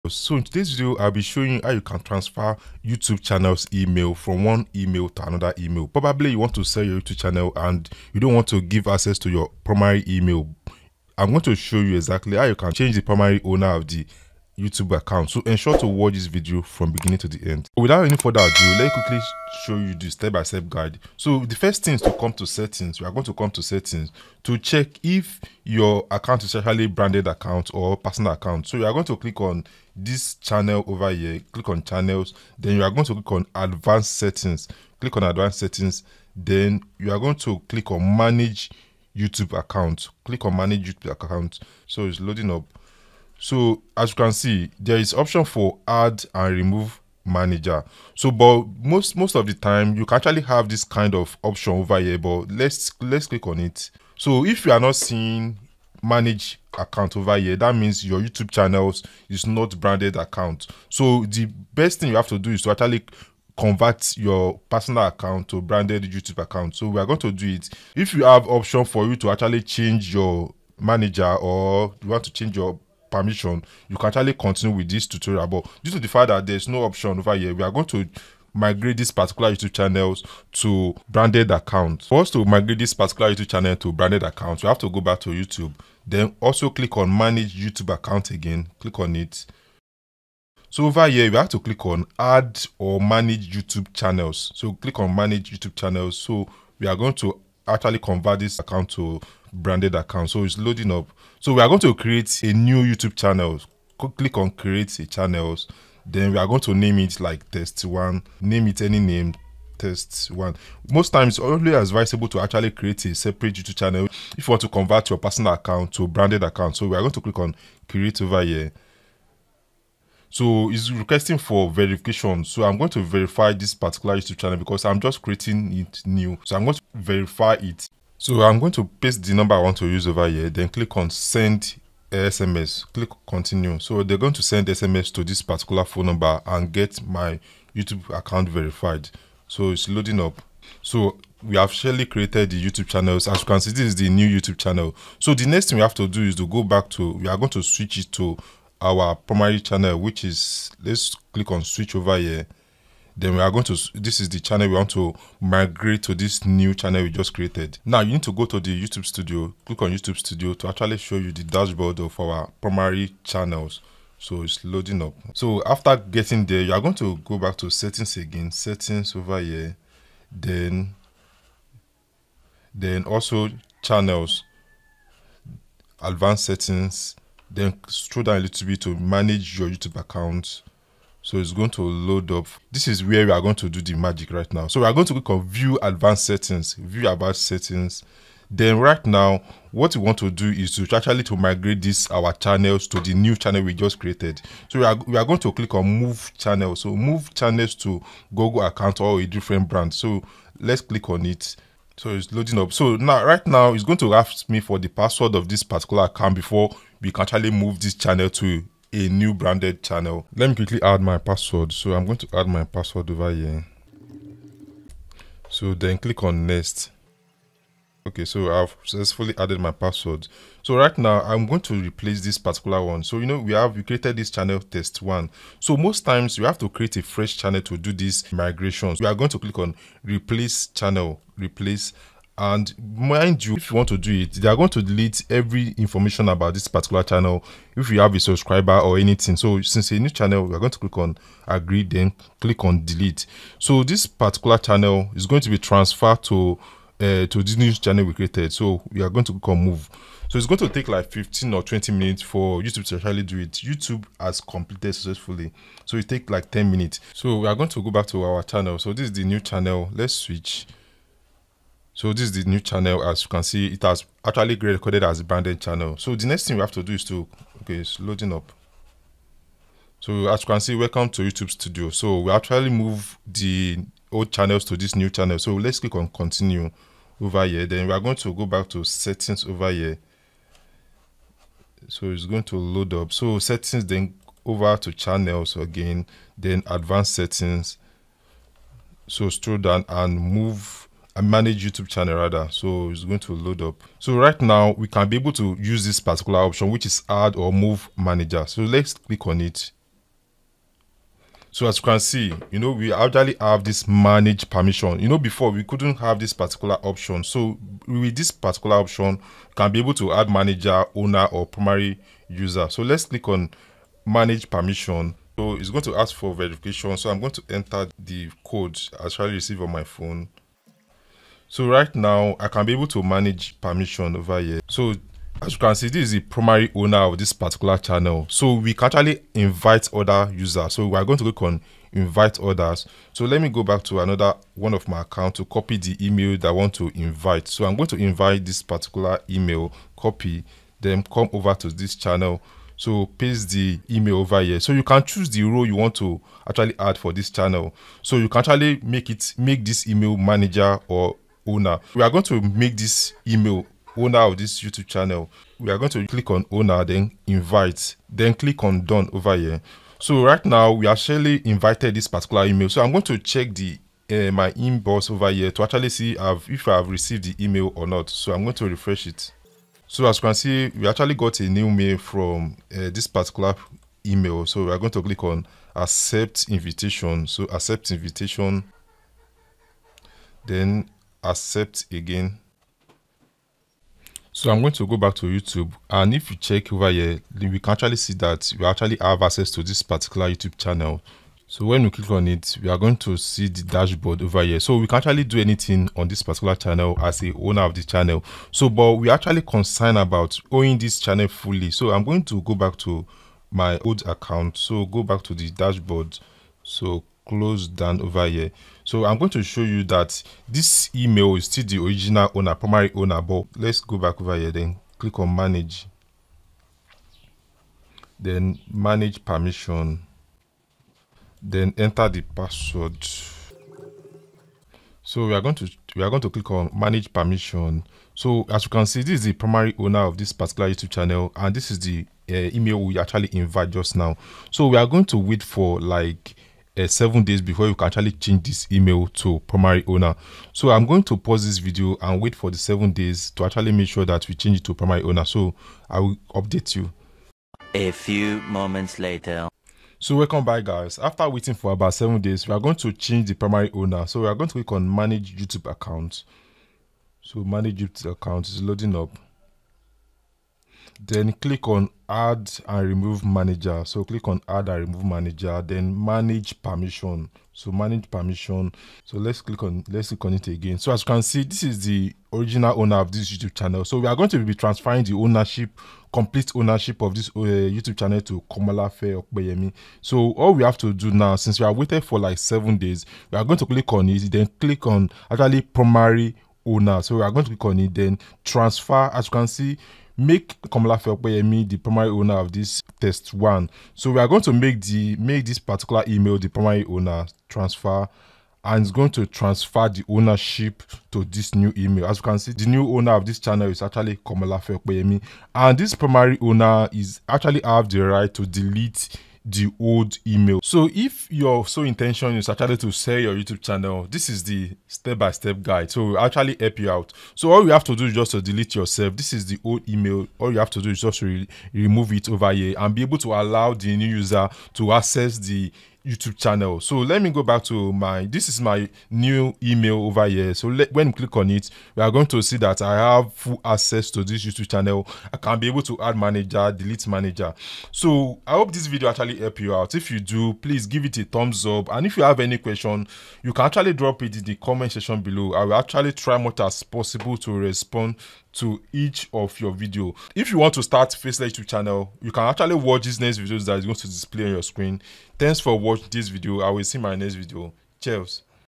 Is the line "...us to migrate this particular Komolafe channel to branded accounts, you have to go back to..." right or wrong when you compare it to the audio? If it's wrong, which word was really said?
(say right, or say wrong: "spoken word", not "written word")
wrong: "YouTube", not "Komolafe".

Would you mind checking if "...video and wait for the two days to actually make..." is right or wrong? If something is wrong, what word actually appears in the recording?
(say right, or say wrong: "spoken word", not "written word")
wrong: "seven", not "two".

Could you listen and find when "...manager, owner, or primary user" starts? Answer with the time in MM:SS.
05:10.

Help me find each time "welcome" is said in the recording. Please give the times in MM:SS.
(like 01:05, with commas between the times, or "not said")
04:30, 07:30.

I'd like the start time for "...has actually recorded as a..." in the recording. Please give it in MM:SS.
04:23.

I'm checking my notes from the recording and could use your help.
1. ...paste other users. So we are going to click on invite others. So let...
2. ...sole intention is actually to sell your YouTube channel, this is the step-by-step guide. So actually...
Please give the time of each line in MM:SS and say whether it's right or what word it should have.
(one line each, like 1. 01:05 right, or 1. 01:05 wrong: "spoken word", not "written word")
1. 05:29 wrong: "invite", not "paste"
2. 08:31 right.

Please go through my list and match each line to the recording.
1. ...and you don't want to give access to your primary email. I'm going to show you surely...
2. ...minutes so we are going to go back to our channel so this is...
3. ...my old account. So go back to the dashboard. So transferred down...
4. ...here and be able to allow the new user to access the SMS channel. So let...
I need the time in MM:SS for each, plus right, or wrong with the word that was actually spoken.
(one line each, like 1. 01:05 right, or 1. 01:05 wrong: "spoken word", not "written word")
1. 00:07 wrong: "exactly", not "surely"
2. 04:16 right
3. 06:43 wrong: "closed", not "transferred"
4. 08:42 wrong: "YouTube", not "SMS".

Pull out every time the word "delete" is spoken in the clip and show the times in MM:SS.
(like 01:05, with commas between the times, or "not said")
03:54, 04:02, 08:28, 08:38, 08:56.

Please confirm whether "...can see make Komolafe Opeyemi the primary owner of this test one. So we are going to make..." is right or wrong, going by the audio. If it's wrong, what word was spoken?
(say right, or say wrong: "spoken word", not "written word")
right.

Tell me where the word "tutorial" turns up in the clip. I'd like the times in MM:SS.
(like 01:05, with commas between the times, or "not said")
01:15.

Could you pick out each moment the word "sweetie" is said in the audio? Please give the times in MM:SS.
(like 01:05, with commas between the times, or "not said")
not said.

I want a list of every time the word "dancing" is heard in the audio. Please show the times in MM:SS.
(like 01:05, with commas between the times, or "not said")
not said.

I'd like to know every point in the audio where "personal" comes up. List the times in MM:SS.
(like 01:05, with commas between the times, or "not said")
00:27, 01:04, 01:55.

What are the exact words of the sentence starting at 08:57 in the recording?
So I hope this video actually help you out.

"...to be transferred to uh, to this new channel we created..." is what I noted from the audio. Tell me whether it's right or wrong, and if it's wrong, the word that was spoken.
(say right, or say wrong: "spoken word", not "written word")
right.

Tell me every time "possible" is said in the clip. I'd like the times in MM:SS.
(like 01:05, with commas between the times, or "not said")
09:06.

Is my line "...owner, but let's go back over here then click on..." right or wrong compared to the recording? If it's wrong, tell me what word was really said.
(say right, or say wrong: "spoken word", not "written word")
right.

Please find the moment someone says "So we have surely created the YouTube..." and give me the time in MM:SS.
02:20.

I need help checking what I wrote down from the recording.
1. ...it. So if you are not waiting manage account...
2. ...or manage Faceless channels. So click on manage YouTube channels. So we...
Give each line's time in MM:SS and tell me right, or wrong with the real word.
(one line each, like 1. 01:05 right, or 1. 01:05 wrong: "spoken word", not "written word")
1. 00:53 wrong: "seeing", not "waiting"
2. 01:32 wrong: "YouTube", not "Faceless".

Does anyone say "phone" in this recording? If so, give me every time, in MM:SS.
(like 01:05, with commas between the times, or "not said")
02:15, 05:19.